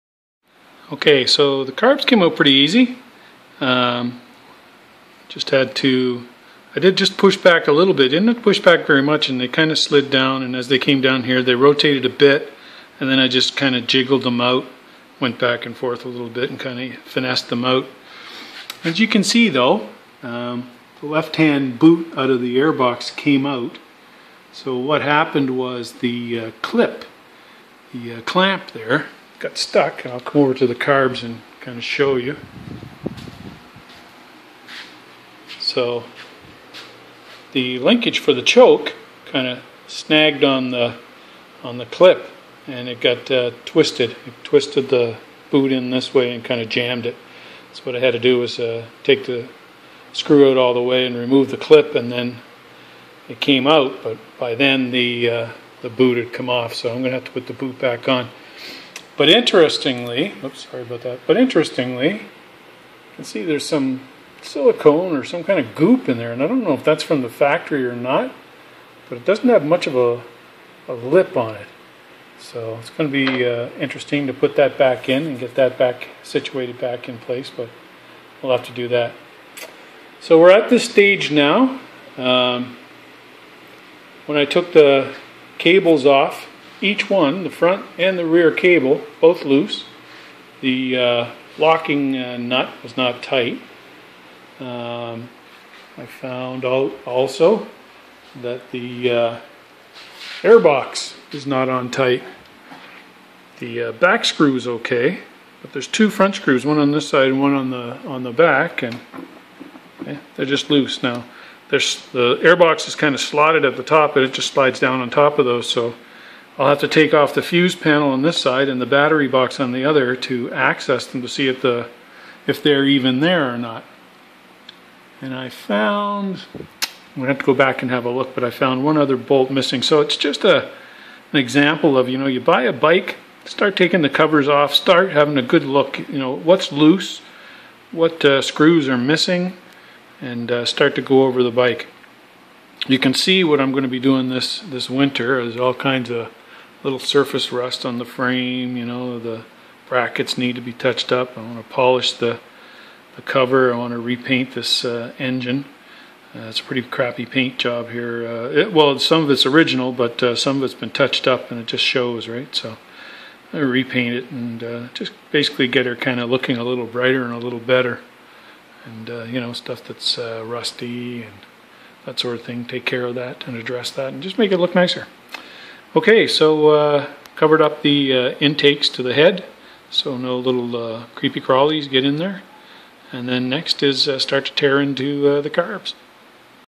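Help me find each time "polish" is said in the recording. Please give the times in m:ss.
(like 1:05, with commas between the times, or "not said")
2:31.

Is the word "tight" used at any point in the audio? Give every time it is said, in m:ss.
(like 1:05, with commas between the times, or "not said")
1:33, 1:41.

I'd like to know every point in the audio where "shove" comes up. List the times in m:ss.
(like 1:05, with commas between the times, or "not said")
not said.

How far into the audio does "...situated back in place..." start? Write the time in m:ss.
1:16.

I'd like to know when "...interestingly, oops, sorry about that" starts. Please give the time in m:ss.
0:59.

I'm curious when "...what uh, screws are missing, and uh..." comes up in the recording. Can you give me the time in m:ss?
2:17.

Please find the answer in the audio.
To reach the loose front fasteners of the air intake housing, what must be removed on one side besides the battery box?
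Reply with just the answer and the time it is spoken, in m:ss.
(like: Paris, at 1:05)
The fuse panel, at 1:57.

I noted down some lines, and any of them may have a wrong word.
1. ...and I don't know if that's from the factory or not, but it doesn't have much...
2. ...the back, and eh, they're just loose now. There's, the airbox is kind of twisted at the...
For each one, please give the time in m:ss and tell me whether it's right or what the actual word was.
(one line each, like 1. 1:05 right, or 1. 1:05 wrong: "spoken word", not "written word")
1. 1:06 right
2. 1:48 wrong: "slotted", not "twisted".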